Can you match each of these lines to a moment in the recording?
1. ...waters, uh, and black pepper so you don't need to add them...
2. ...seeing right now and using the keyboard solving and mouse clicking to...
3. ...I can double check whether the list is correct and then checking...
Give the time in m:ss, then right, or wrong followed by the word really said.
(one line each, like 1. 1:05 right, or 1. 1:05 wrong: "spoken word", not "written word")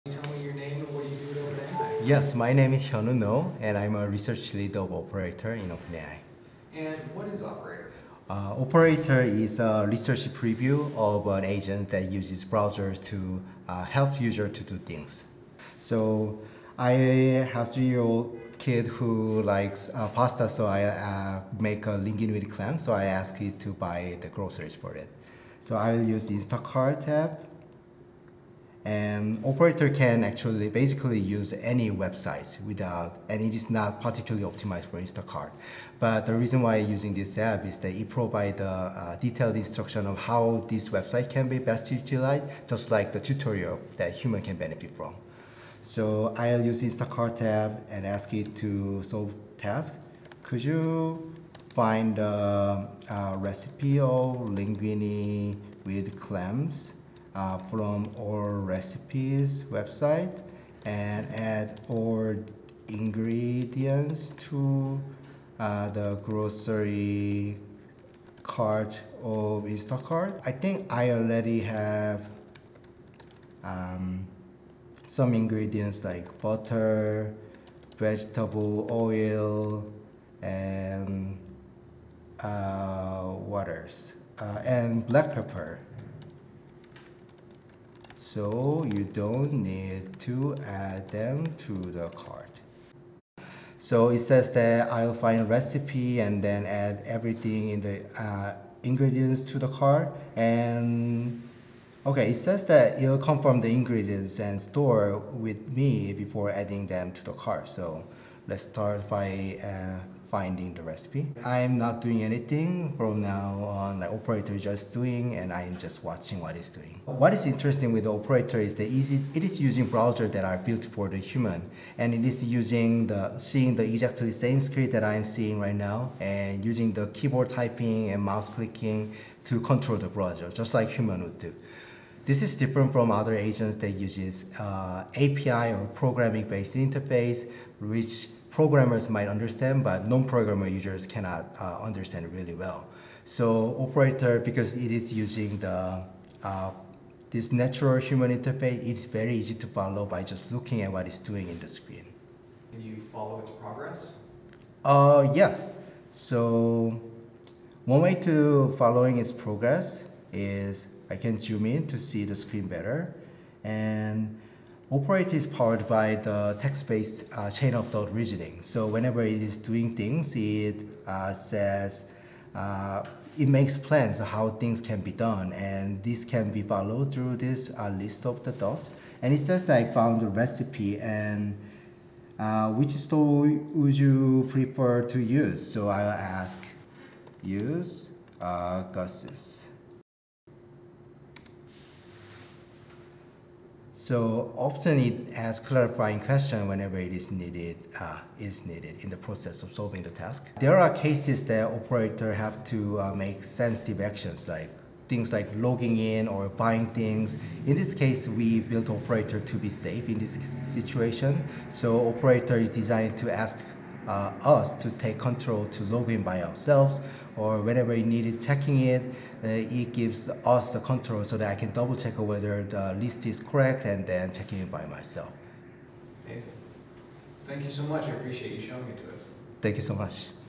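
1. 1:23 right
2. 2:05 wrong: "typing", not "solving"
3. 3:41 right.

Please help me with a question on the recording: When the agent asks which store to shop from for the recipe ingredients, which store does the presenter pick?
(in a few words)
Gus's.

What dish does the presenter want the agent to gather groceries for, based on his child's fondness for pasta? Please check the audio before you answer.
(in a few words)
Linguine with clam.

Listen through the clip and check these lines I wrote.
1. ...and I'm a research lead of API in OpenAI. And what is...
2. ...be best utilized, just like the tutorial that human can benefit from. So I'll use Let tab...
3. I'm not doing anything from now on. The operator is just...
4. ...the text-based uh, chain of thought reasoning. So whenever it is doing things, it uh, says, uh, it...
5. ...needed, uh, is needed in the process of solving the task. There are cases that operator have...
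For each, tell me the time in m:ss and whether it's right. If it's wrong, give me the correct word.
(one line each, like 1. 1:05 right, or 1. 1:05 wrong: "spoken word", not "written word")
1. 0:03 wrong: "Operator", not "API"
2. 0:41 wrong: "Instacart", not "Let"
3. 1:51 right
4. 2:46 right
5. 3:17 right.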